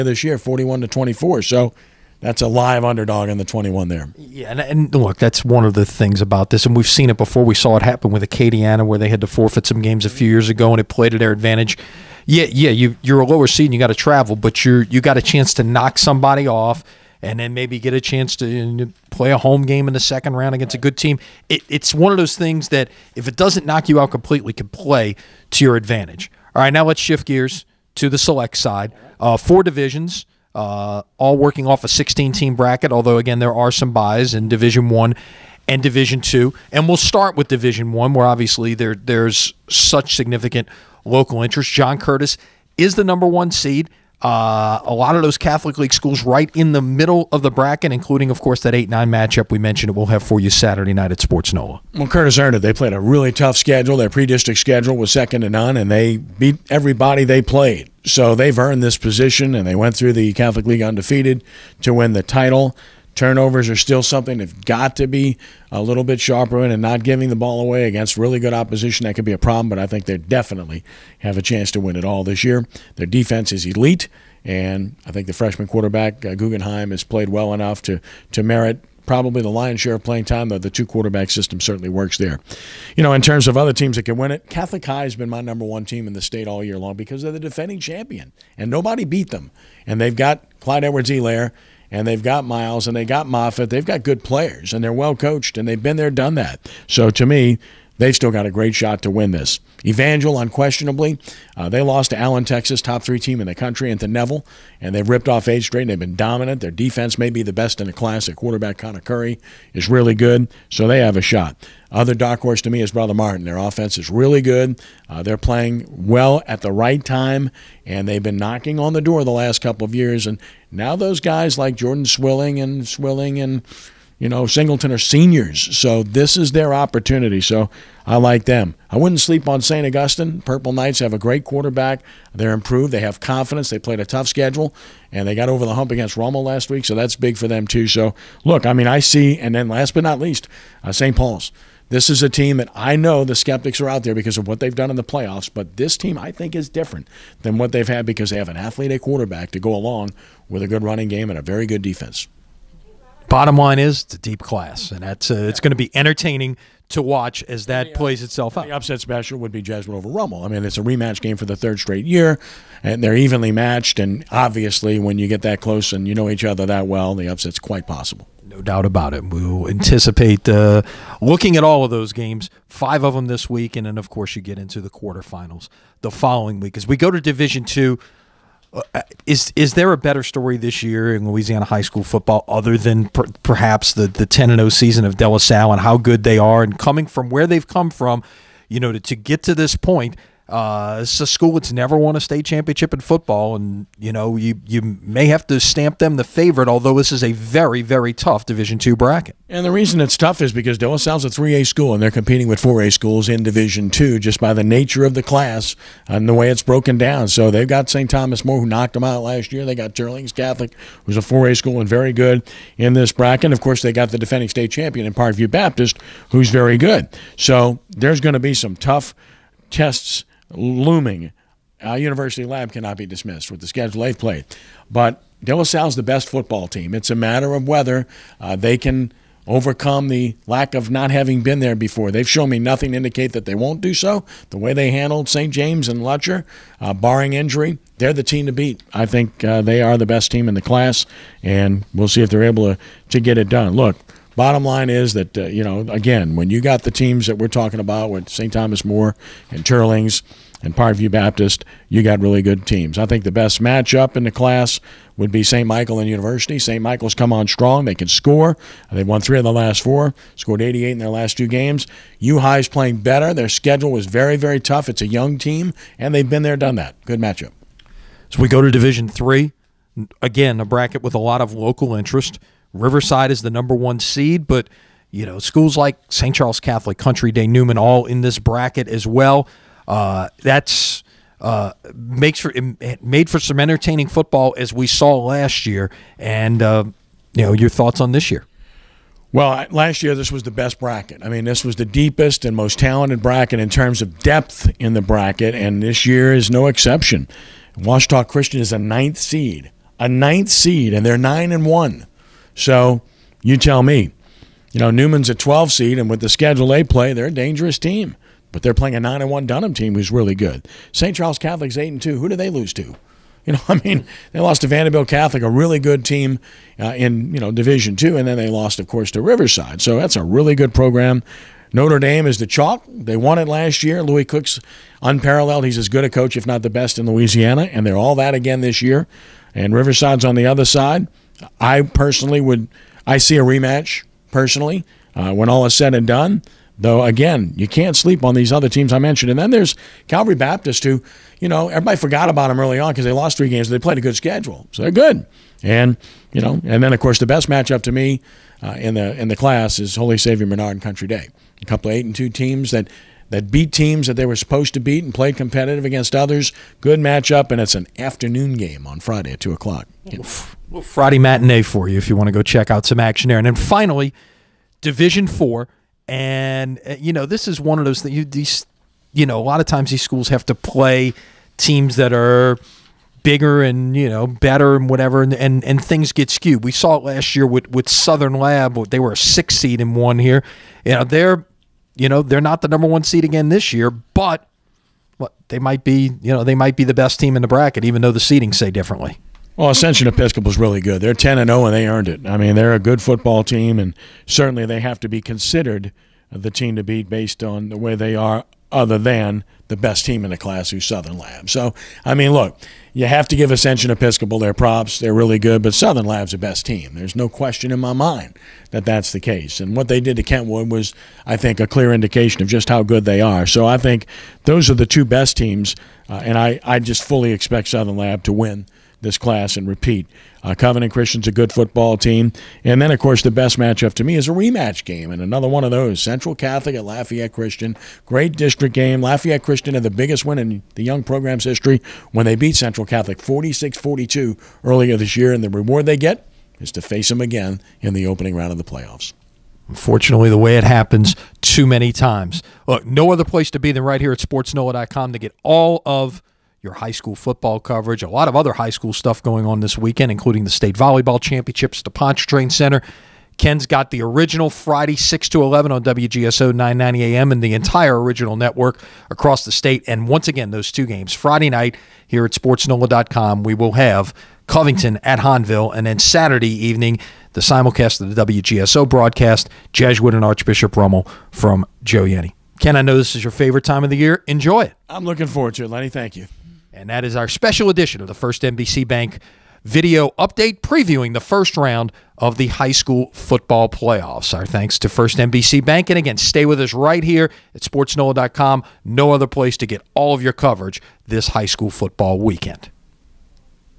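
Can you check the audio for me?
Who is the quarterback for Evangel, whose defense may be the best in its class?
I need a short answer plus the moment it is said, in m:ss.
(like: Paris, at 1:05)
Connor Curry, at 1:48.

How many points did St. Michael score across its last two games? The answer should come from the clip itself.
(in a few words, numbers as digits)
88.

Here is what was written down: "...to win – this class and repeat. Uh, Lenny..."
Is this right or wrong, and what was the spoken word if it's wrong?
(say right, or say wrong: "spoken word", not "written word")
wrong: "Covenant", not "Lenny".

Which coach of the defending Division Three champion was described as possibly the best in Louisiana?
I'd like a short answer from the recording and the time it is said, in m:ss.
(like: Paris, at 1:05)
Lewis Cook, at 5:24.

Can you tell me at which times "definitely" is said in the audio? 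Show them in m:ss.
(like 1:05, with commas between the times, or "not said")
1:10.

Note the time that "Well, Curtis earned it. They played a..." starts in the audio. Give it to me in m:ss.
0:51.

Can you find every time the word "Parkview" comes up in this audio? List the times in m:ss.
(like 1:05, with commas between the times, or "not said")
3:35, 4:10.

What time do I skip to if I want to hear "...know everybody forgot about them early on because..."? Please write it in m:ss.
5:41.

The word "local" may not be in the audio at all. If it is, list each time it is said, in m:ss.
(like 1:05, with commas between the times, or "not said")
0:41, 4:31.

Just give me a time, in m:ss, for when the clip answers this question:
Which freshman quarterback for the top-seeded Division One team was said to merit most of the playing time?
1:16.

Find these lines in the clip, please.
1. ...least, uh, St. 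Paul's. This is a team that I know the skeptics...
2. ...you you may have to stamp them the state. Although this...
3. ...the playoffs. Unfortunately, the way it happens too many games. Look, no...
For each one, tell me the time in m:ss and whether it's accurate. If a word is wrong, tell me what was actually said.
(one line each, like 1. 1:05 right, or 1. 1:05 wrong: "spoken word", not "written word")
1. 2:20 right
2. 3:14 wrong: "favorite", not "state"
3. 7:18 wrong: "times", not "games".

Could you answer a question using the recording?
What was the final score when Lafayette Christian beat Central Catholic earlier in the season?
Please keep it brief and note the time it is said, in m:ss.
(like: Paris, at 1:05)
46-42, at 7:13.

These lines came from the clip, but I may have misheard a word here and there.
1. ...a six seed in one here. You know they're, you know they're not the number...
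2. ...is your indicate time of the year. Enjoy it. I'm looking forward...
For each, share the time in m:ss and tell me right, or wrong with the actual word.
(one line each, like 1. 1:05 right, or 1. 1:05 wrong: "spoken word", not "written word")
1. 6:19 right
2. 7:53 wrong: "favorite", not "indicate".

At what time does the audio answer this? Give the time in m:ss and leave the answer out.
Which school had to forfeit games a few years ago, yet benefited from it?
0:08.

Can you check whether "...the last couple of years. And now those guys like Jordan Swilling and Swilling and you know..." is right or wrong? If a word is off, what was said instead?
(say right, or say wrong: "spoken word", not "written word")
right.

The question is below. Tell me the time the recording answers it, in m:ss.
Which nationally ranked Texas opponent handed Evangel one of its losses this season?
1:42.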